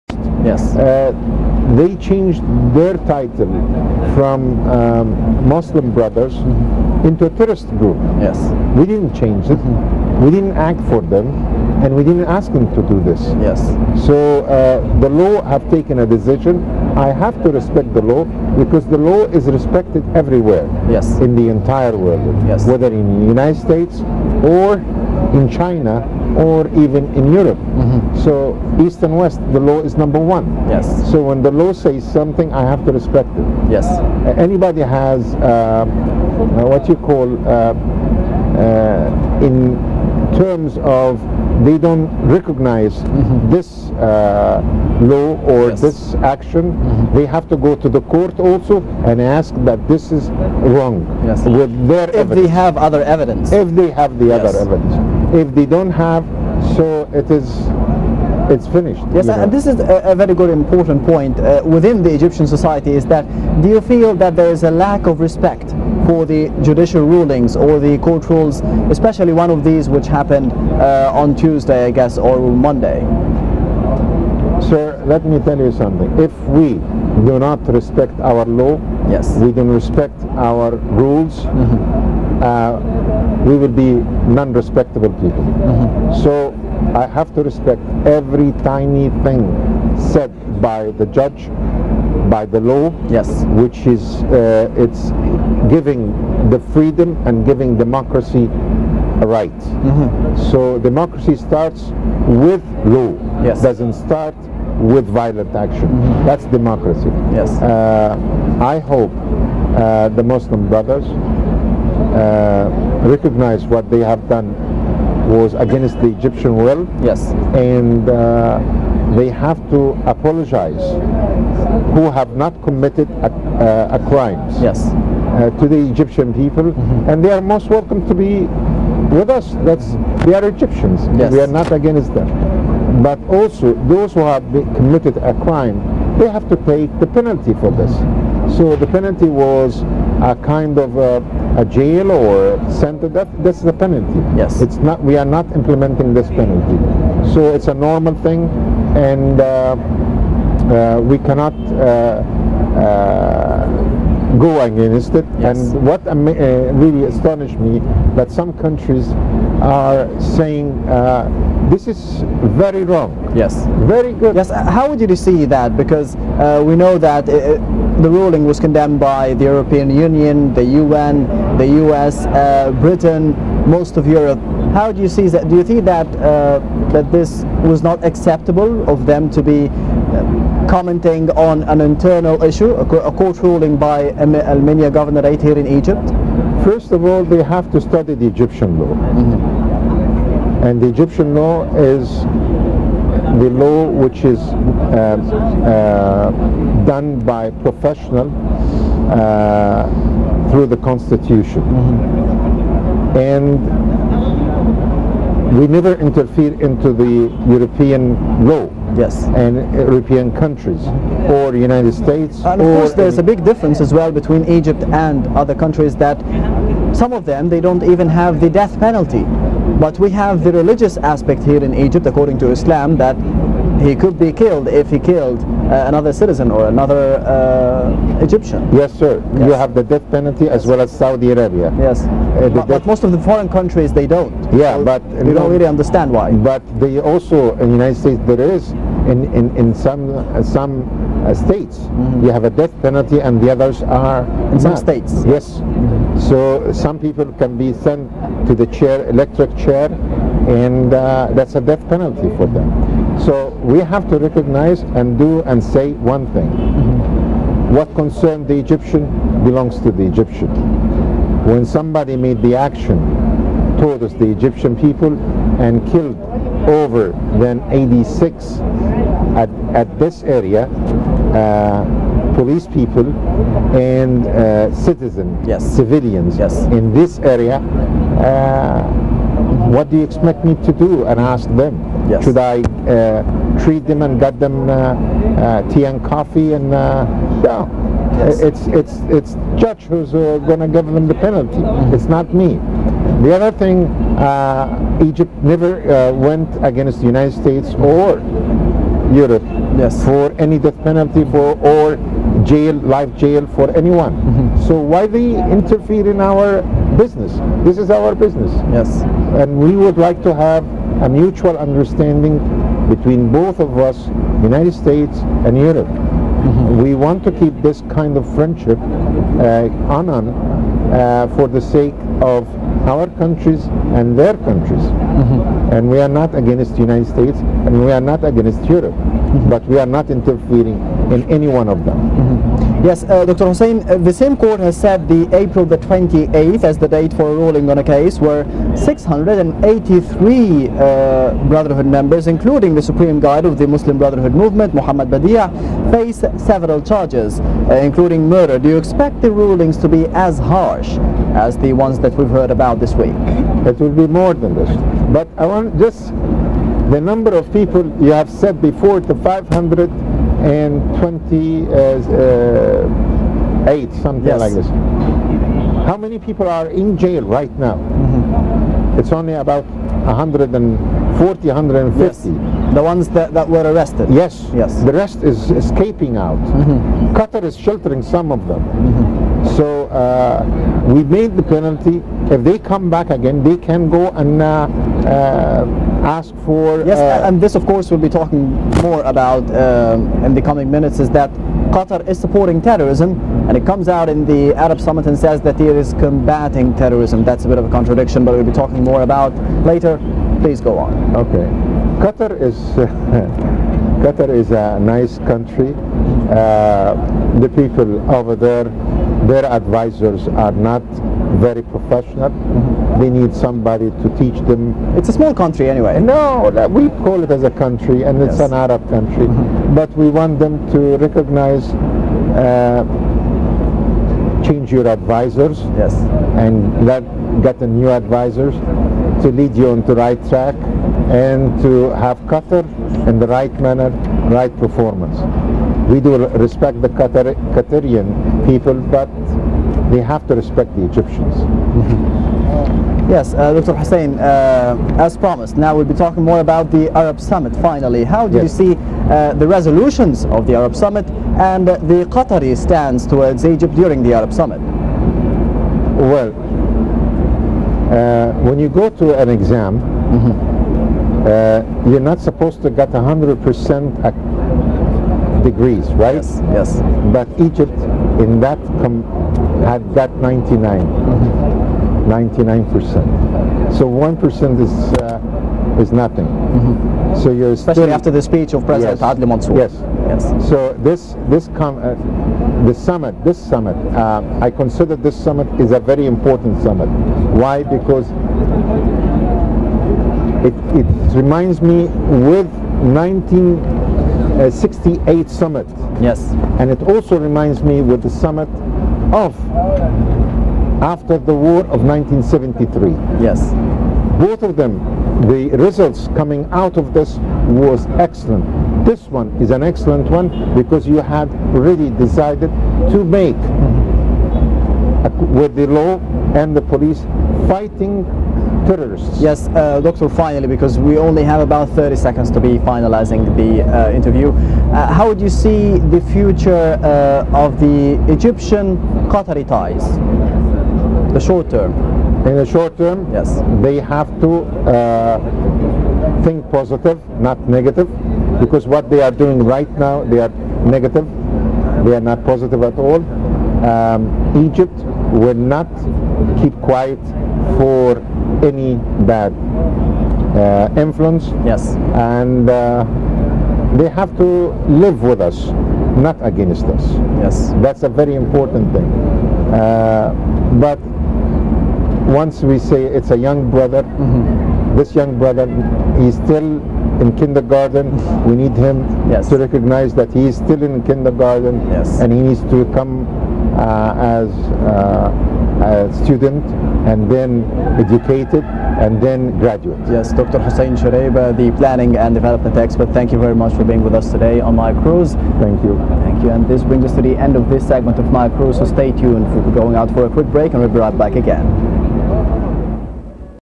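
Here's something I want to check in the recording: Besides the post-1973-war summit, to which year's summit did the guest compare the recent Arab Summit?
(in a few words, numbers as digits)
1968.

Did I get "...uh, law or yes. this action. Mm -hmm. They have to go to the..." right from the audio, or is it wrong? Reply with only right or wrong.
right.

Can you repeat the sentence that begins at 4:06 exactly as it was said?
So some people can be sent to the chair, electric chair, and uh, that's a death penalty for them.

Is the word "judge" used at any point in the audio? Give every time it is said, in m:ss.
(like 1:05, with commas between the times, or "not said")
1:31, 4:49.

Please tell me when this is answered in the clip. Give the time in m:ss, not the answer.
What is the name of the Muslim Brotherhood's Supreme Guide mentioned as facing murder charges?
5:44.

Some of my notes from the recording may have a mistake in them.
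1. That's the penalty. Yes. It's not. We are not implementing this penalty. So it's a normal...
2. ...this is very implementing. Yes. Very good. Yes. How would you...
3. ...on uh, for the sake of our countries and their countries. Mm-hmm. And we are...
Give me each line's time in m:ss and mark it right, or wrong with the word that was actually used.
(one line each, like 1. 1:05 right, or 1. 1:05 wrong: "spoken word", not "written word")
1. 2:23 right
2. 2:41 wrong: "wrong", not "implementing"
3. 5:19 right.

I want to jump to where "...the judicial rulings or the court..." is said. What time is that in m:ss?
1:06.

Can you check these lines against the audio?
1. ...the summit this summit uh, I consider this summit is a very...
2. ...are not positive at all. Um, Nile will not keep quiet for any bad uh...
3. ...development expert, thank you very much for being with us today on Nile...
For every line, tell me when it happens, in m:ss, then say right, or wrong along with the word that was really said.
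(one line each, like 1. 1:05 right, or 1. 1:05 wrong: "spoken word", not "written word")
1. 8:02 right
2. 9:01 wrong: "Egypt", not "Nile"
3. 9:42 right.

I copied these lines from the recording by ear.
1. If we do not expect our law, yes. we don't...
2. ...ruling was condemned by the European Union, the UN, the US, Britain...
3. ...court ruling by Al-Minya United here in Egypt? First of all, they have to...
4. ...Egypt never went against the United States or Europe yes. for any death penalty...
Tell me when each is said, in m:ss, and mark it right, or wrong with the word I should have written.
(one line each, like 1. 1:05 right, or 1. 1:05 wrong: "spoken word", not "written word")
1. 1:16 wrong: "respect", not "expect"
2. 2:48 right
3. 3:03 wrong: "Governorate", not "United"
4. 4:55 right.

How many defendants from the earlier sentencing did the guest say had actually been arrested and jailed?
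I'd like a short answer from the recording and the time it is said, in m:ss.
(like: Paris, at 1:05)
140 to 150, at 6:10.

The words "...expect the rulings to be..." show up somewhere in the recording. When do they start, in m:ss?
5:48.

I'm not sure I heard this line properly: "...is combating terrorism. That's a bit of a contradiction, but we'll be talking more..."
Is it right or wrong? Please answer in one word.
right.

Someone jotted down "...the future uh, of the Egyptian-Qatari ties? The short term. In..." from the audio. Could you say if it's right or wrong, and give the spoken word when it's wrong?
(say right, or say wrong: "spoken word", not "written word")
right.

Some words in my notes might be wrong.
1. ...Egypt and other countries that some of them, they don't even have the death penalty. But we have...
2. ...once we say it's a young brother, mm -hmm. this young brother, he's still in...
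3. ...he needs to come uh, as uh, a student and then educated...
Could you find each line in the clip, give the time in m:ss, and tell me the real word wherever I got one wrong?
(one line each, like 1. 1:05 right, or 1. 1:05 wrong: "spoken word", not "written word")
1. 3:34 right
2. 9:22 right
3. 9:32 right.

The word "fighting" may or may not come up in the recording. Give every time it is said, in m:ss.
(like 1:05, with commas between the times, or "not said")
8:37.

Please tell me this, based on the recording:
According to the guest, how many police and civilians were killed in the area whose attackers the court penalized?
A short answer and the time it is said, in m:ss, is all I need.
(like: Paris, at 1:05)
86, at 4:27.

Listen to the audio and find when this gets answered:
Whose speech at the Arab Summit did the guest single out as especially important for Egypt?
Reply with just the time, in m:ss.
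7:59.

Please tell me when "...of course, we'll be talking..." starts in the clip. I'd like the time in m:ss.
6:27.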